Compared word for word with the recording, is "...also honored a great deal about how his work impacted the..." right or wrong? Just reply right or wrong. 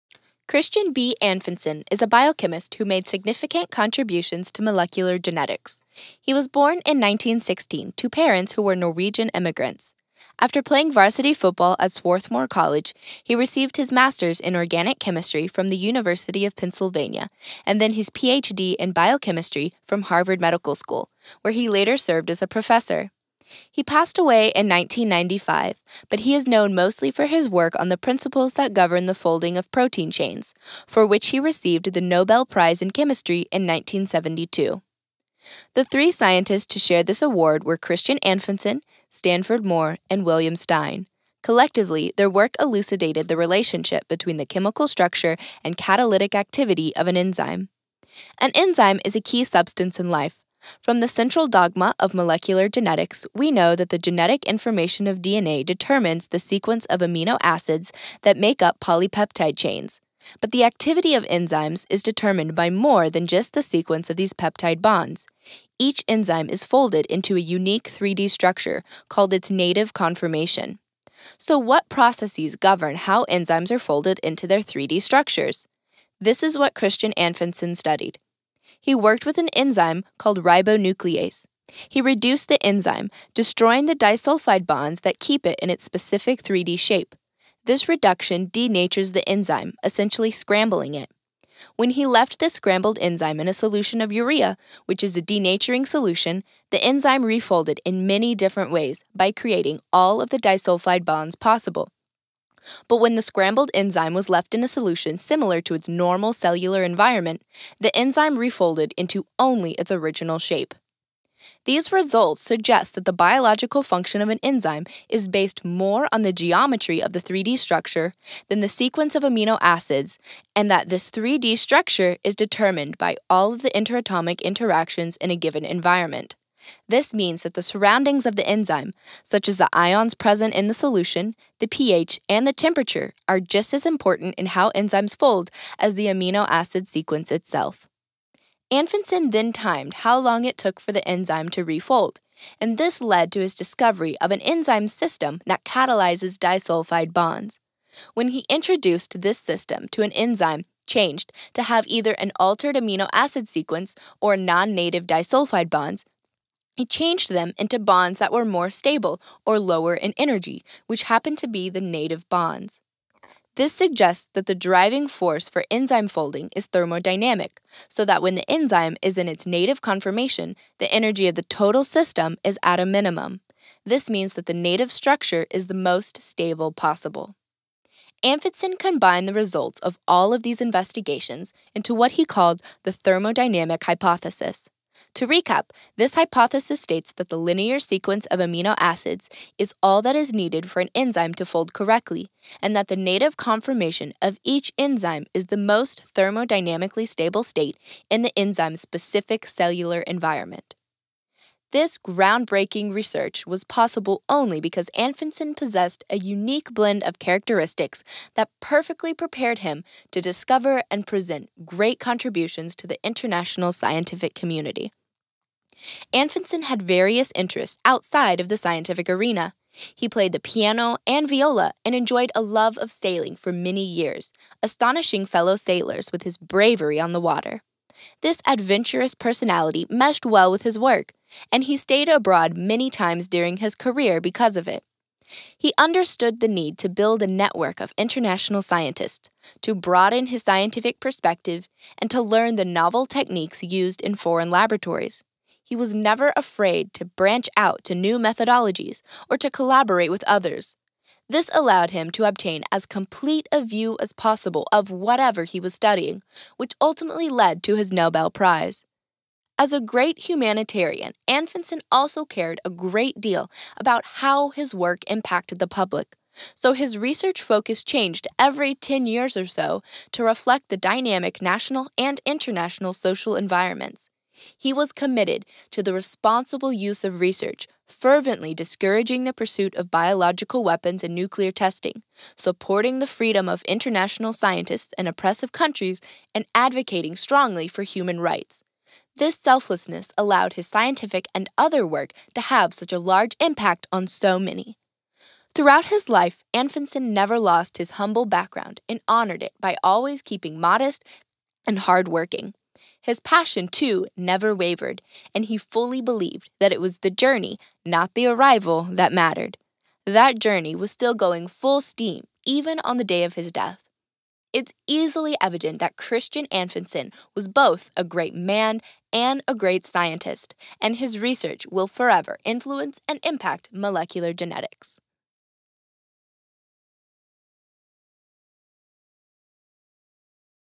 wrong.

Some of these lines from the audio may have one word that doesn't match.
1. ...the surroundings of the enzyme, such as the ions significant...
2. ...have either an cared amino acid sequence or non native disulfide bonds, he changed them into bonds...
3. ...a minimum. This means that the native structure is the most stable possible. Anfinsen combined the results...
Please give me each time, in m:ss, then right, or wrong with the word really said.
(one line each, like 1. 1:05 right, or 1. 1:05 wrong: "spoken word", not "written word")
1. 2:07 wrong: "present", not "significant"
2. 2:31 wrong: "altered", not "cared"
3. 2:52 right.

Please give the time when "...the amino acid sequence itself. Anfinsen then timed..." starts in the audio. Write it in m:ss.
2:15.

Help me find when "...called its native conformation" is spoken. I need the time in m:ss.
1:09.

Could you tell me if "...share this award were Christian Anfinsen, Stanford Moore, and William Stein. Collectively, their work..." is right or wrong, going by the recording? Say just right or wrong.
right.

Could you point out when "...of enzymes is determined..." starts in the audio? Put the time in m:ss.
1:01.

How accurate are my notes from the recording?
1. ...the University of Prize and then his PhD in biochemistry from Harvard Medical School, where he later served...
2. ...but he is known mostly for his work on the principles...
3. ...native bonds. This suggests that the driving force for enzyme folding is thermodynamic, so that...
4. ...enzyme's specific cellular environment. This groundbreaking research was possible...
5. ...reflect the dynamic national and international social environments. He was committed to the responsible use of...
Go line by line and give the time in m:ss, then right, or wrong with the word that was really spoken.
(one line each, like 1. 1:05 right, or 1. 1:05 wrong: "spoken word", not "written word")
1. 0:15 wrong: "Pennsylvania", not "Prize"
2. 0:26 right
3. 2:41 right
4. 3:18 right
5. 4:30 right.